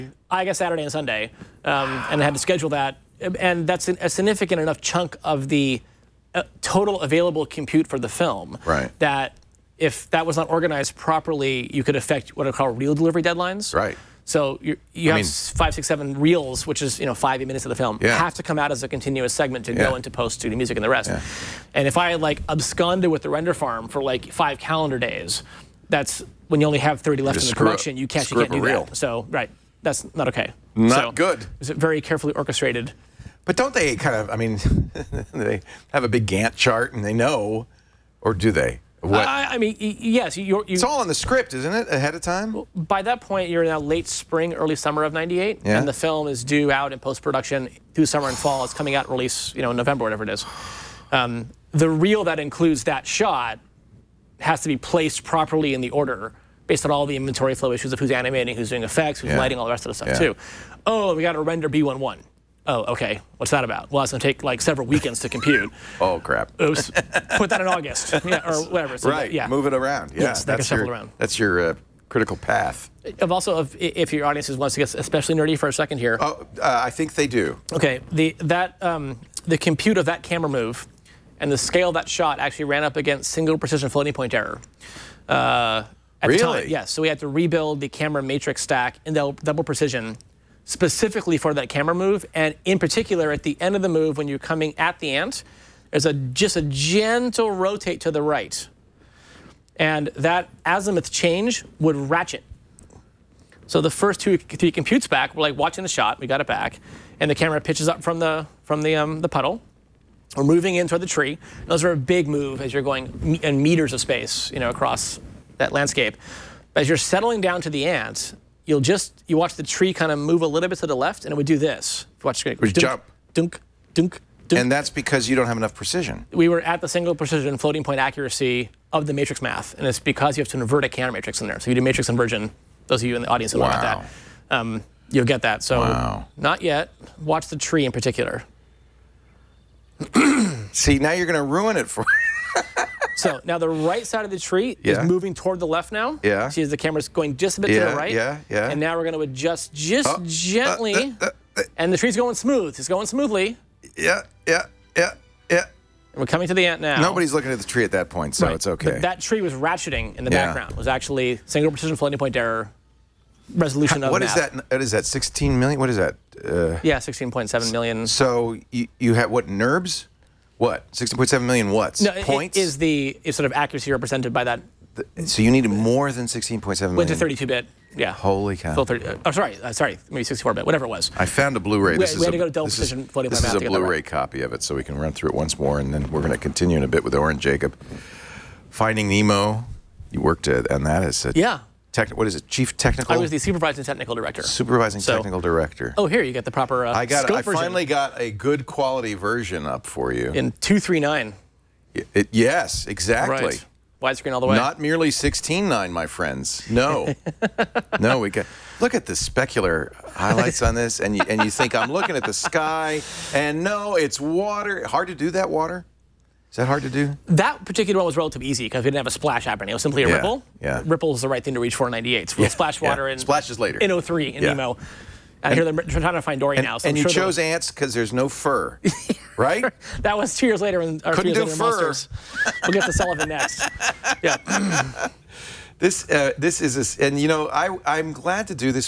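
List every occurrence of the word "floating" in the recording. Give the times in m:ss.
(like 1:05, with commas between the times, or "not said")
1:23, 2:07, 2:41, 3:03.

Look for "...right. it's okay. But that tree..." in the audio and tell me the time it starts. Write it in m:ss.
2:38.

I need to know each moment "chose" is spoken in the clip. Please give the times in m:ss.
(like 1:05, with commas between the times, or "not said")
3:47.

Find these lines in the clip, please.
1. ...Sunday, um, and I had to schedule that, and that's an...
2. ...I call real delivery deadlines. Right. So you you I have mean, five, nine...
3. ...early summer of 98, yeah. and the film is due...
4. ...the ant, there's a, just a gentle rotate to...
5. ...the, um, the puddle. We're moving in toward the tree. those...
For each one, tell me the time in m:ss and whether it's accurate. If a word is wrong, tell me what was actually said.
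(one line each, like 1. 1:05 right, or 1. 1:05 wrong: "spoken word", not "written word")
1. 0:00 right
2. 0:12 wrong: "six", not "nine"
3. 0:44 right
4. 1:34 right
5. 1:48 right.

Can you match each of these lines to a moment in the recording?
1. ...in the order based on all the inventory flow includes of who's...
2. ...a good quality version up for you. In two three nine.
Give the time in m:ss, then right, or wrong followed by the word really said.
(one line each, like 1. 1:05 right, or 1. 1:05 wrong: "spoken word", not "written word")
1. 0:55 wrong: "issues", not "includes"
2. 3:18 right.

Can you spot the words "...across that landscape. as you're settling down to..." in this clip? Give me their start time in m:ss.
1:54.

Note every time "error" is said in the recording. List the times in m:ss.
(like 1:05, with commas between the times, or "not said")
1:24, 2:42.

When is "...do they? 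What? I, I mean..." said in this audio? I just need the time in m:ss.
0:38.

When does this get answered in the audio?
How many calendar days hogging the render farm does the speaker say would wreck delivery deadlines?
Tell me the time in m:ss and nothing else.
0:24.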